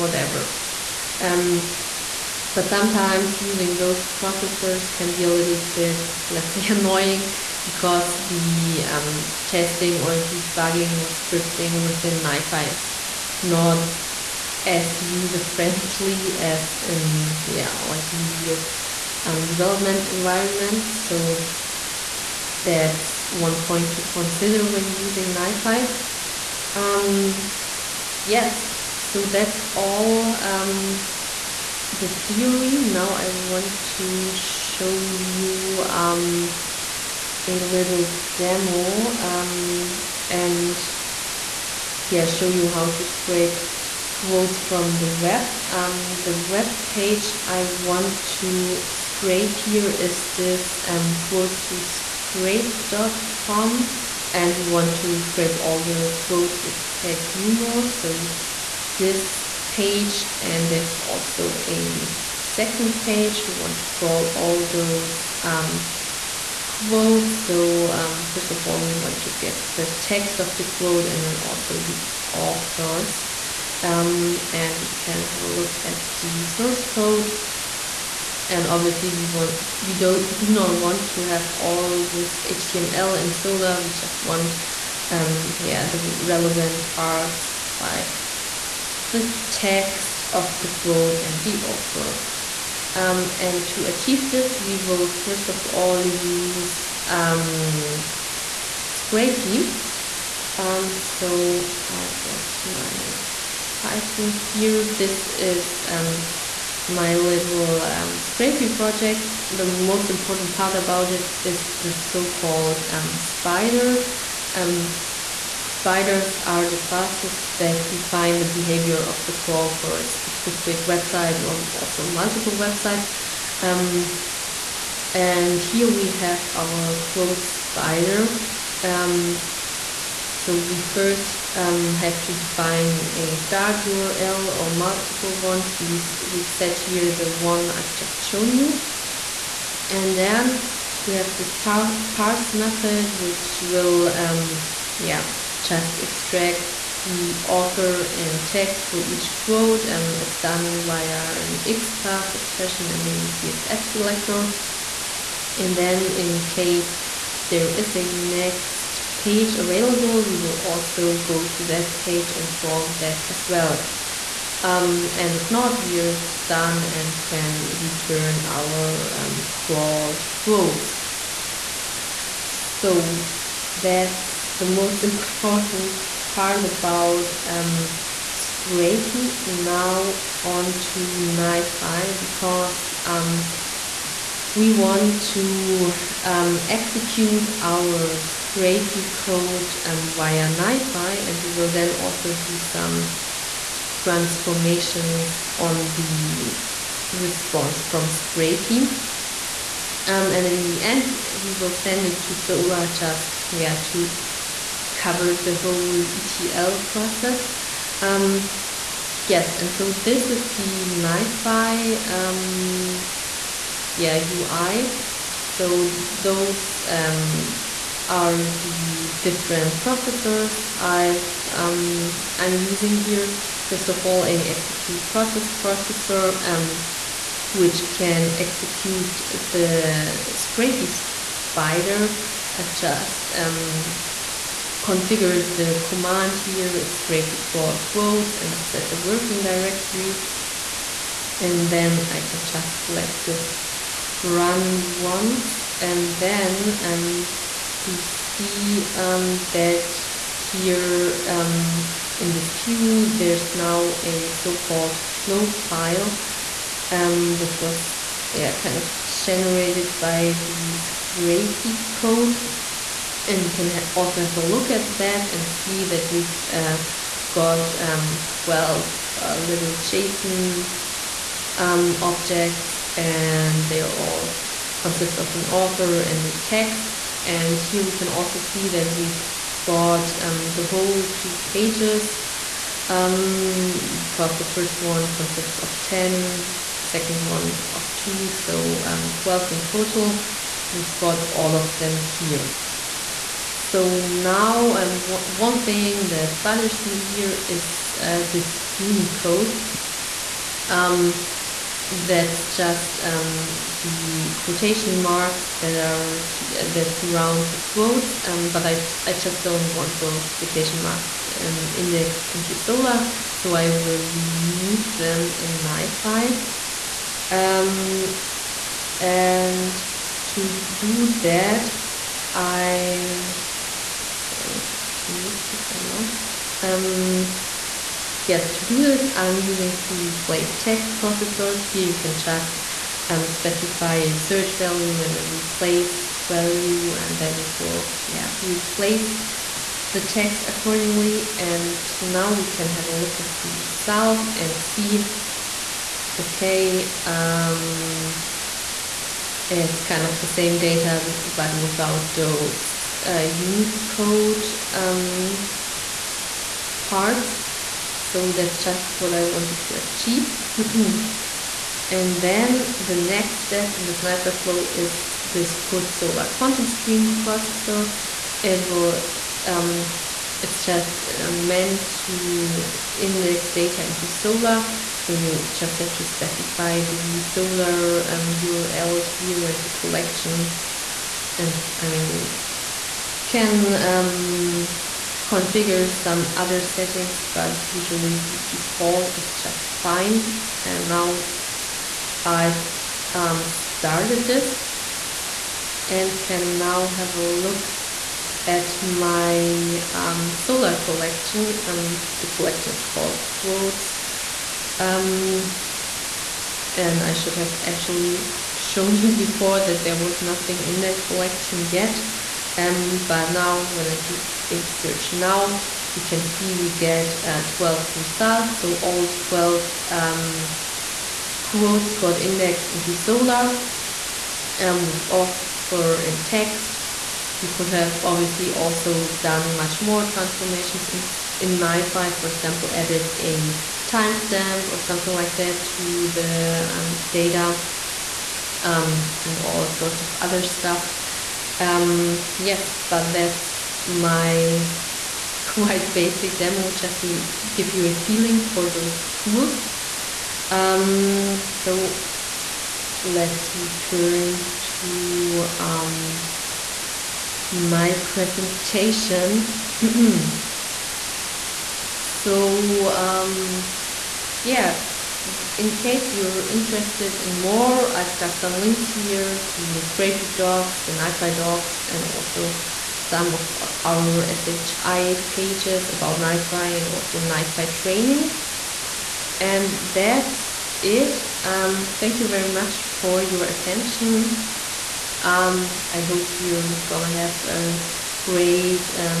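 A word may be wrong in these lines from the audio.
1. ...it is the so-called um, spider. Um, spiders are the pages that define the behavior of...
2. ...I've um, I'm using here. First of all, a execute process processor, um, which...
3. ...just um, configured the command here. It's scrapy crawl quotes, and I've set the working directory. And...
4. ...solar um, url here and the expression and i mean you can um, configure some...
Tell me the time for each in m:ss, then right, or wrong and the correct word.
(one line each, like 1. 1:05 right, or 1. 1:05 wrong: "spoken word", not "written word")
1. 1:51 wrong: "classes", not "pages"
2. 3:40 right
3. 3:52 right
4. 6:17 wrong: "collection", not "expression".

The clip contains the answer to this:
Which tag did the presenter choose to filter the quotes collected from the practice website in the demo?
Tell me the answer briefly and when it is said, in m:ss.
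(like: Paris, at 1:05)
humor, at 0:57.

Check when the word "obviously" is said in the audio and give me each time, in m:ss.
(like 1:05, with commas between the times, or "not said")
1:18, 7:08.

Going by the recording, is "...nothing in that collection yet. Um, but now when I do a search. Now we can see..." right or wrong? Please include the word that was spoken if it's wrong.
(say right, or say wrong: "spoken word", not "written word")
right.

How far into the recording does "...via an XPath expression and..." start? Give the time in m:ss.
2:30.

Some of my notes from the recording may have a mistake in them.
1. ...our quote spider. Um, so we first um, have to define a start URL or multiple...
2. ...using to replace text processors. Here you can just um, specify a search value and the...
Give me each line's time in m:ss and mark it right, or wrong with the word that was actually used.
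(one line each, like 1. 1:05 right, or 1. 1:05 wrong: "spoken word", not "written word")
1. 2:06 right
2. 5:29 right.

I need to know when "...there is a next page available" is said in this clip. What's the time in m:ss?
2:37.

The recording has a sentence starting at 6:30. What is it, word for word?
And now I've um, started this and can now have a look at my um, Solr collection.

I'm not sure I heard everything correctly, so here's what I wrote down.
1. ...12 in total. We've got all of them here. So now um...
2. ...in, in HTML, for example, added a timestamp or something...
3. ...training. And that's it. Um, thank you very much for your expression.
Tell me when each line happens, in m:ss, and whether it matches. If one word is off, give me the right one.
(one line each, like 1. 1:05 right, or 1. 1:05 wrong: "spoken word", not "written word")
1. 4:49 right
2. 7:11 wrong: "NiFi", not "HTML"
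3. 7:57 wrong: "attention", not "expression".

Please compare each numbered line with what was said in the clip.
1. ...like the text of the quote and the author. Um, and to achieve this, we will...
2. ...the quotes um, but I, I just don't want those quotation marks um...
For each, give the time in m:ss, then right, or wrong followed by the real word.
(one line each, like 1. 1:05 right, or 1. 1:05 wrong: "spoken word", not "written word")
1. 1:27 right
2. 5:07 right.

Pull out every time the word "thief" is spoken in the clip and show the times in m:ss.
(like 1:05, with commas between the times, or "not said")
not said.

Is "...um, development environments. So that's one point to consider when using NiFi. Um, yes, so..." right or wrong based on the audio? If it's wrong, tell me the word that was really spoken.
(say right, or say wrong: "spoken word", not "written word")
right.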